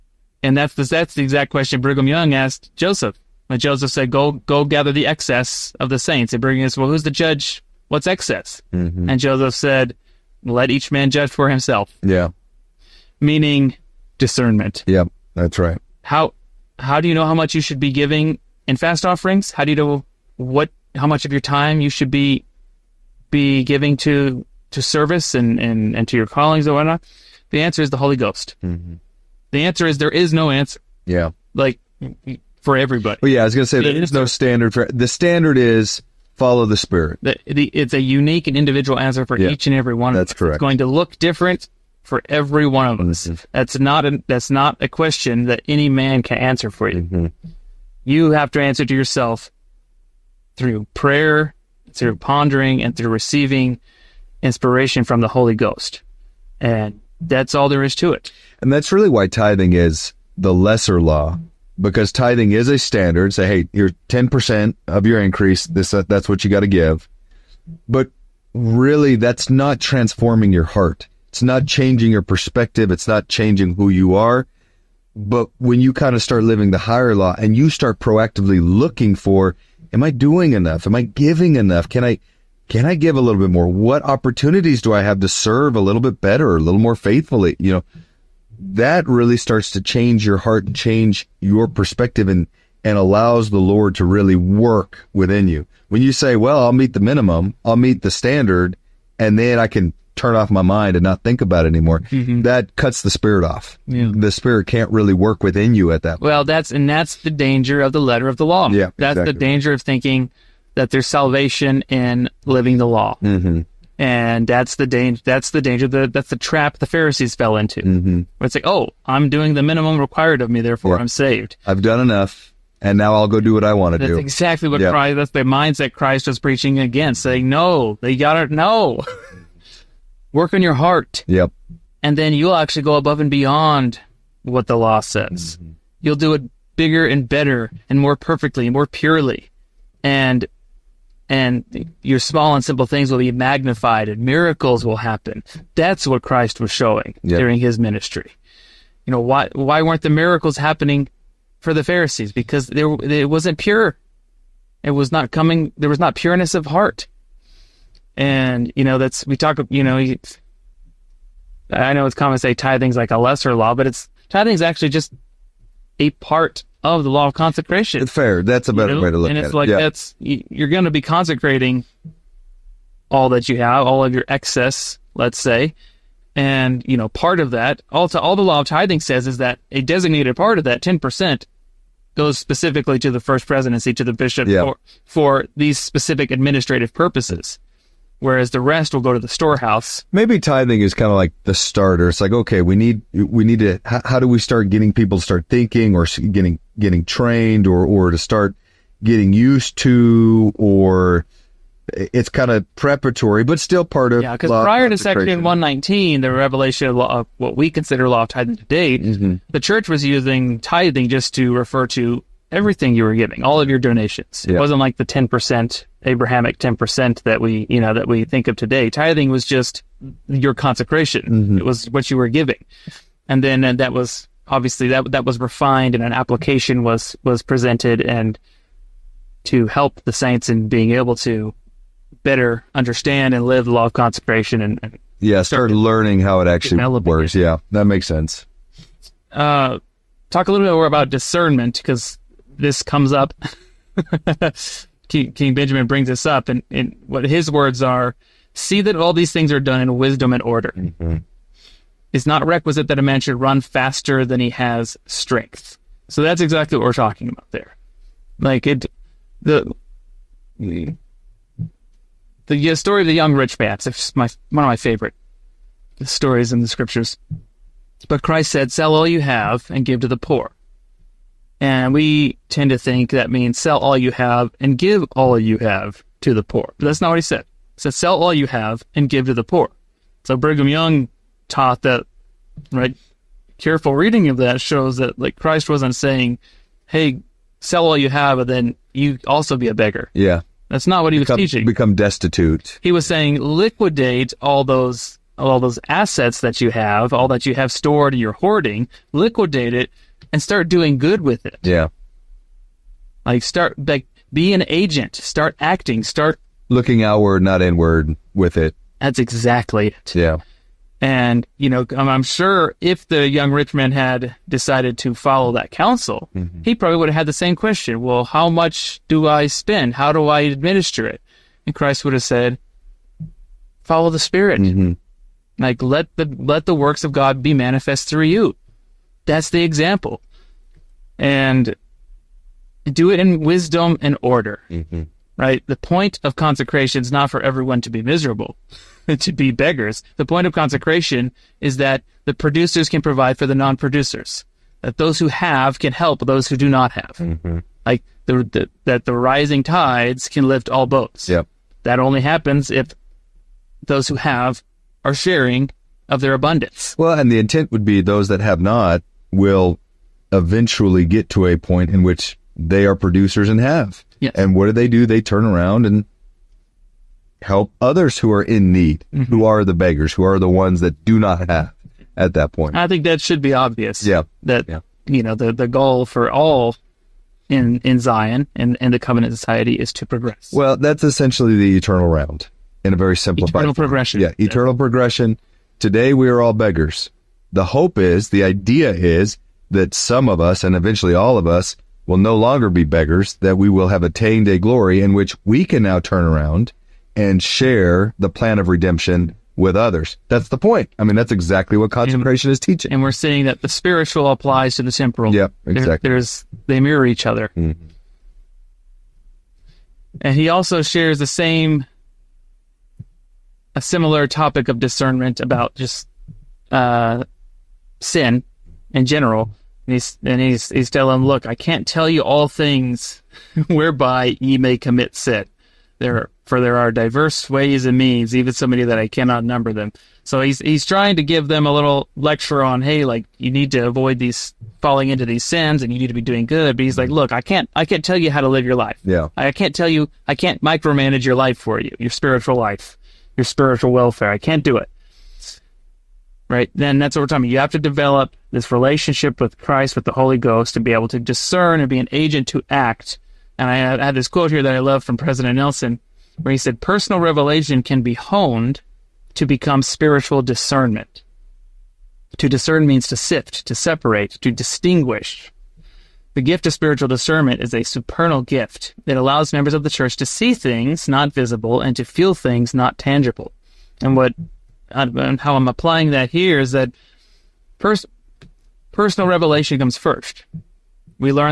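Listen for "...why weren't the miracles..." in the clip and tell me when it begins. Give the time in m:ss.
2:29.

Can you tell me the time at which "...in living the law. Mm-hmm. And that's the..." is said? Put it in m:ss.
1:51.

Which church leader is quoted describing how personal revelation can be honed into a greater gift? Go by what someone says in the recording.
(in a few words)
President Nelson.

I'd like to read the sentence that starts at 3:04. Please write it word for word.
for, for these specific administrative purposes whereas the rest will go to the storehouse.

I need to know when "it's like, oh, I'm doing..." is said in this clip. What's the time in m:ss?
1:58.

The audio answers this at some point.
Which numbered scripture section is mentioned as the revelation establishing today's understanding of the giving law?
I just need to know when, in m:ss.
3:24.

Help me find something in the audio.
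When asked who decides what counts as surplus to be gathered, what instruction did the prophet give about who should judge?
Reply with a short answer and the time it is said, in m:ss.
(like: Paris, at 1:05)
Let each man judge for himself, at 0:10.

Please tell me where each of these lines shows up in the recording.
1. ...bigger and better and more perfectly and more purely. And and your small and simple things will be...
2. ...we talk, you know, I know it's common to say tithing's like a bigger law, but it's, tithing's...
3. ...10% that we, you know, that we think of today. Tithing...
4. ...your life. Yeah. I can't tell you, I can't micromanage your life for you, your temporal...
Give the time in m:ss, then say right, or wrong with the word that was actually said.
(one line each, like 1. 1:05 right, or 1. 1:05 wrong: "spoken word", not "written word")
1. 2:16 right
2. 2:39 wrong: "lesser", not "bigger"
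3. 3:36 right
4. 7:18 wrong: "spiritual", not "temporal".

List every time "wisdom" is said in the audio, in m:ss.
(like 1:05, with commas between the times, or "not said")
4:09, 5:33.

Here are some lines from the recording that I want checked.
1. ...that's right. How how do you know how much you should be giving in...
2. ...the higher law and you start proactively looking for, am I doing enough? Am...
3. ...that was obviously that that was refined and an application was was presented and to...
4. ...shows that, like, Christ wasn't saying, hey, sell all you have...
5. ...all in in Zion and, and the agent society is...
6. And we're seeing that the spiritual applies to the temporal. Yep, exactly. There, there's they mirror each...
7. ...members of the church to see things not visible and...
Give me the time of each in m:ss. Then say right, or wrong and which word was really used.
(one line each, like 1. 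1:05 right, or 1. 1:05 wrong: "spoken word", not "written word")
1. 0:15 right
2. 1:16 right
3. 3:43 right
4. 4:44 right
5. 6:16 wrong: "covenant", not "agent"
6. 6:42 right
7. 7:49 right.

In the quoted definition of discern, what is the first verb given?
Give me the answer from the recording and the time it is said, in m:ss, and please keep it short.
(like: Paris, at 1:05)
Sift, at 7:43.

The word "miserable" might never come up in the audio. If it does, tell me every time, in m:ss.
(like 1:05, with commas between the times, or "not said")
5:38.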